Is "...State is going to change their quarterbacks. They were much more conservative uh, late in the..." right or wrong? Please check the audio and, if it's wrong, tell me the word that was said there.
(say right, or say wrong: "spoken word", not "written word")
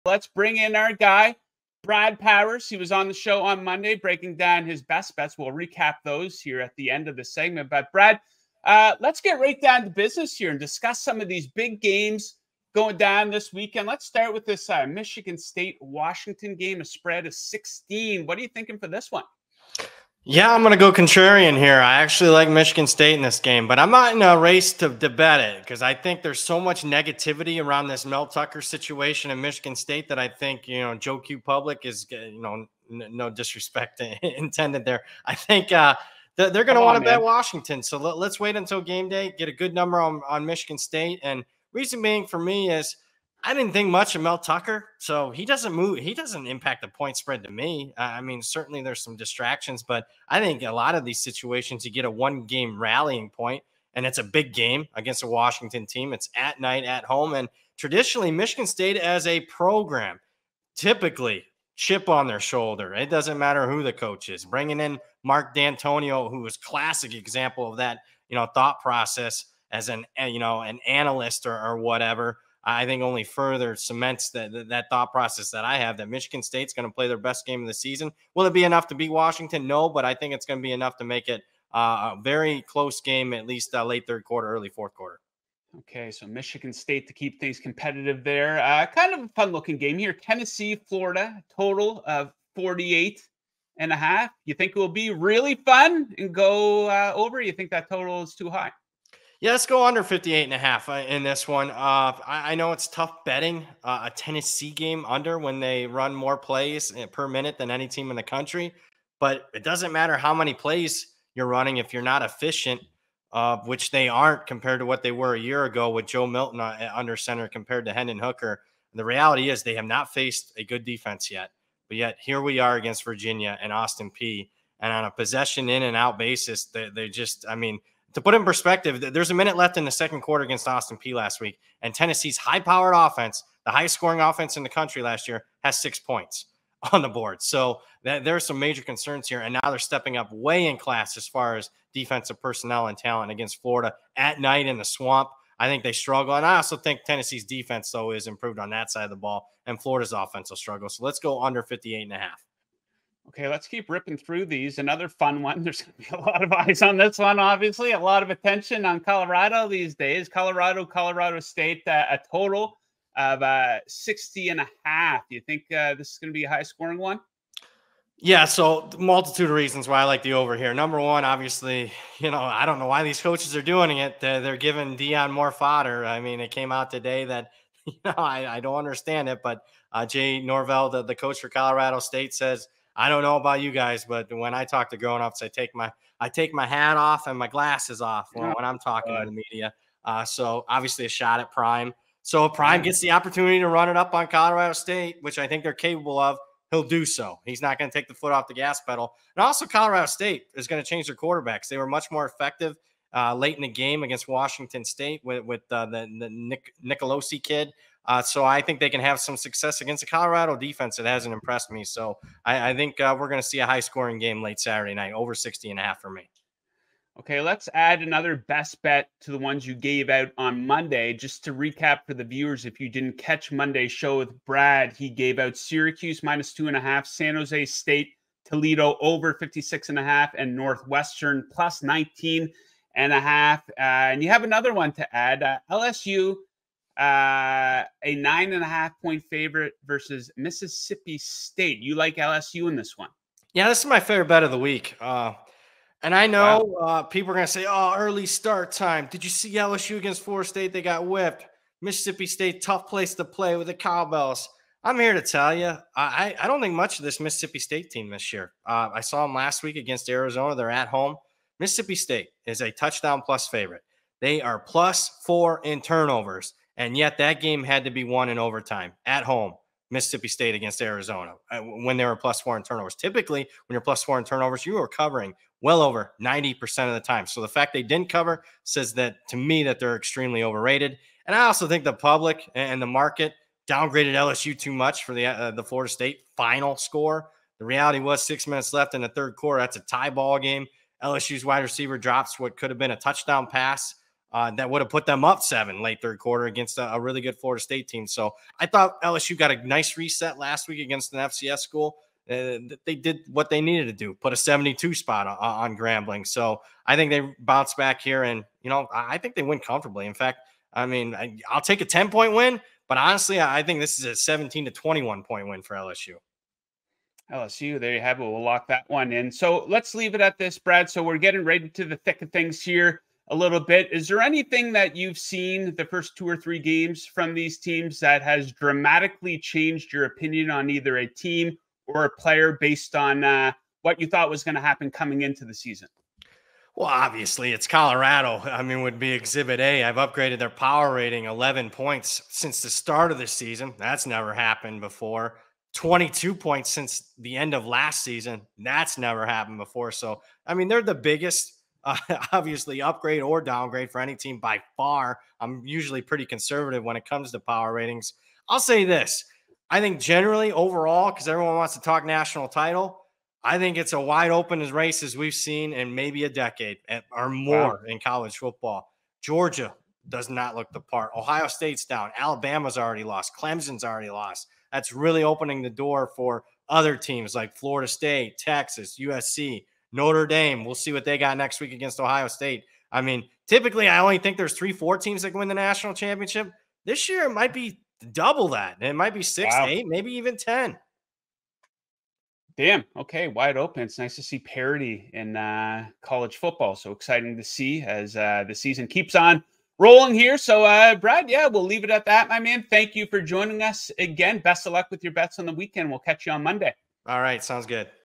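wrong: "effective", not "conservative".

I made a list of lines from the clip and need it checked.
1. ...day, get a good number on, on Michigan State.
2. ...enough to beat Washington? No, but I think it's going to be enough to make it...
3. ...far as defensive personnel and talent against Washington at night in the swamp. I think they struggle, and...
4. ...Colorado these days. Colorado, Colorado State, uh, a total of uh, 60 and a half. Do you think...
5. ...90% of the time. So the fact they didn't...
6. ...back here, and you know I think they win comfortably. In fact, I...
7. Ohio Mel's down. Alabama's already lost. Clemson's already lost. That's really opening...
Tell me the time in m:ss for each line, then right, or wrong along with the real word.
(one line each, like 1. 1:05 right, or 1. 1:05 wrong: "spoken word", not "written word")
1. 0:39 right
2. 1:18 right
3. 2:21 wrong: "Florida", not "Washington"
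4. 2:38 right
5. 4:36 right
6. 5:07 right
7. 6:11 wrong: "State", not "Mel".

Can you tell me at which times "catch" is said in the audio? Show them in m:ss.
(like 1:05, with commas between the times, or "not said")
3:43, 6:45.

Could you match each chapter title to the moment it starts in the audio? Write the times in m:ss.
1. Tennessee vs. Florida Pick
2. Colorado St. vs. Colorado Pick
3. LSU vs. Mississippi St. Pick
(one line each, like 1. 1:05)
1. 1:26
2. 2:38
3. 3:54.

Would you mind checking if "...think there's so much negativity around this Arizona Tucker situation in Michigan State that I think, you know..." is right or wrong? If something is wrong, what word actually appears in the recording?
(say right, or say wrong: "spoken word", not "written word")
wrong: "Mel", not "Arizona".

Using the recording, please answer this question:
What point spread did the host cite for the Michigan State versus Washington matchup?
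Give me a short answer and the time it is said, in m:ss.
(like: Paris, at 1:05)
16, at 0:17.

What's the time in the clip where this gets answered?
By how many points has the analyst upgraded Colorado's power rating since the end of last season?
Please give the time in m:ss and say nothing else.
5:45.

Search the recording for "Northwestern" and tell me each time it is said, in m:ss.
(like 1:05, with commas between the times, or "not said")
3:50.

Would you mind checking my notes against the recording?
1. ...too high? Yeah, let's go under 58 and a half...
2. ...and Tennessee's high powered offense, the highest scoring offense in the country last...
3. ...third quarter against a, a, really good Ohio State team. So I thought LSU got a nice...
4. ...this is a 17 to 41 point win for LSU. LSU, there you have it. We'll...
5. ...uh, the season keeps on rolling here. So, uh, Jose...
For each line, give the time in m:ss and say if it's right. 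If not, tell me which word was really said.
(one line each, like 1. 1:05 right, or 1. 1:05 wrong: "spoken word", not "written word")
1. 1:38 right
2. 2:11 right
3. 4:56 wrong: "Florida", not "Ohio"
4. 5:13 wrong: "21", not "41"
5. 6:38 wrong: "Brad", not "Jose".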